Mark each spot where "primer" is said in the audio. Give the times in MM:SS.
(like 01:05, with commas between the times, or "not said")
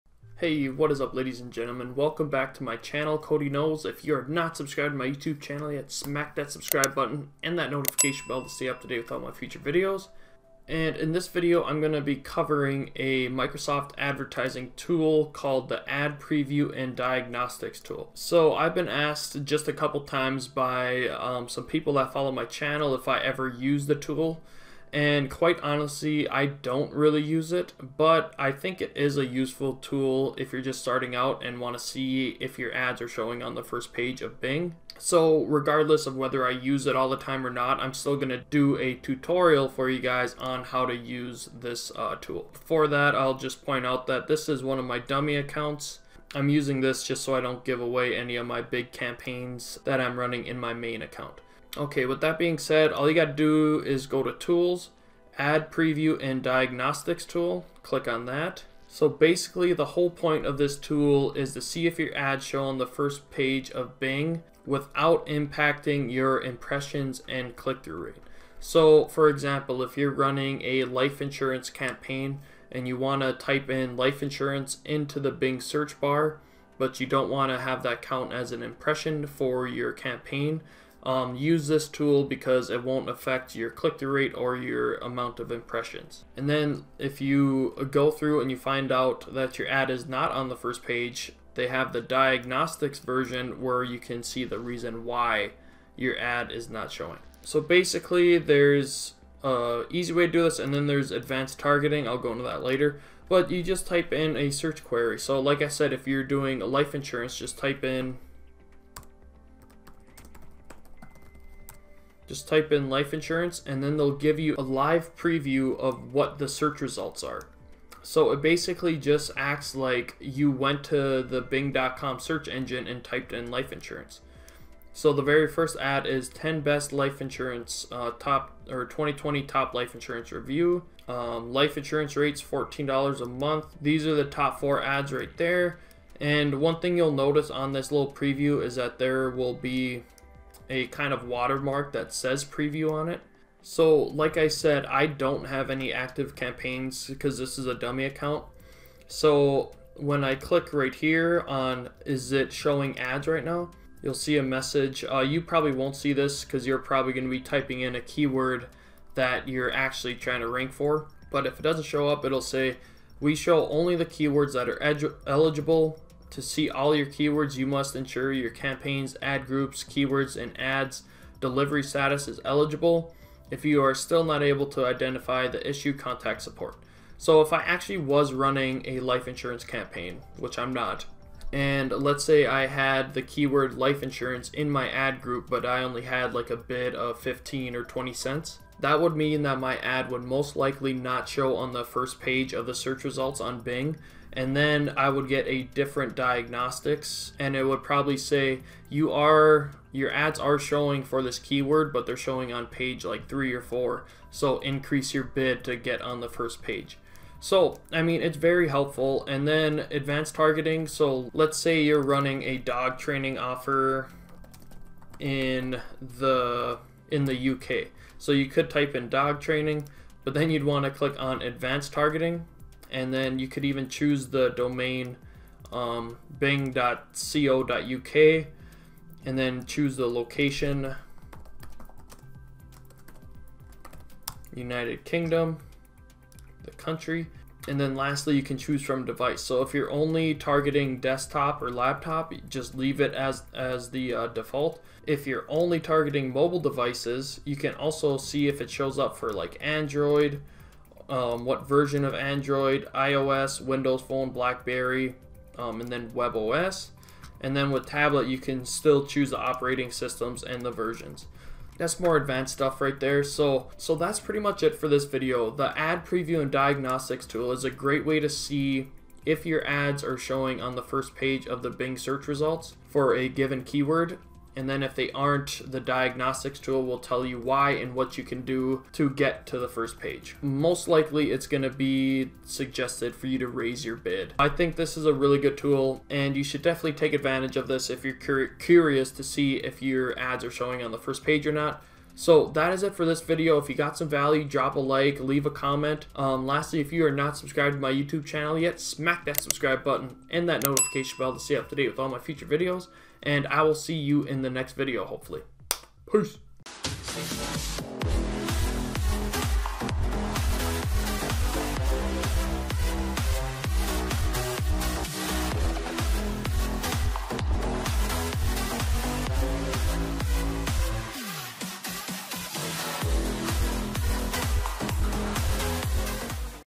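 not said.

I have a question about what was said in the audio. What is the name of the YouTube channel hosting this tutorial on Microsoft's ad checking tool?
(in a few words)
Kody Knows.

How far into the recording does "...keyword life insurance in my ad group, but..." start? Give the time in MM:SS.
03:03.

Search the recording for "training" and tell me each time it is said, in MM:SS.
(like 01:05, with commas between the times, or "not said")
03:32, 03:39.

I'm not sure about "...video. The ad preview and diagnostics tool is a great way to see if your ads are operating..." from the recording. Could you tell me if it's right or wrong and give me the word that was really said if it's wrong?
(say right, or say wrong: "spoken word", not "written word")
wrong: "showing", not "operating".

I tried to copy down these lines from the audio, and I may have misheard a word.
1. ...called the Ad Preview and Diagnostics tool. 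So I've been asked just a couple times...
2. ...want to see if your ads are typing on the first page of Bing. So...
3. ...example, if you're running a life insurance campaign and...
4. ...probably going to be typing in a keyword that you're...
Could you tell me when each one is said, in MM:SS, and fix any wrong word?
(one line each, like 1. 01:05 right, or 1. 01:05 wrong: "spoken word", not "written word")
1. 00:15 right
2. 00:31 wrong: "showing", not "typing"
3. 01:09 right
4. 02:36 right.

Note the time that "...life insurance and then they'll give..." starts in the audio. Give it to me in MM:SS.
01:52.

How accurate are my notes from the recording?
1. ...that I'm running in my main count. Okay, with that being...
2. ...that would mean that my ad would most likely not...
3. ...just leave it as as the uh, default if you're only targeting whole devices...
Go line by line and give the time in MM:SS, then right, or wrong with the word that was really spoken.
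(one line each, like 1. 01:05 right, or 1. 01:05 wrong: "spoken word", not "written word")
1. 00:49 wrong: "account", not "count"
2. 03:08 right
3. 04:02 wrong: "mobile", not "whole".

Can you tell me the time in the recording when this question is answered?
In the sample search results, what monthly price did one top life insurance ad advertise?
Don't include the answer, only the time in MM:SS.
02:12.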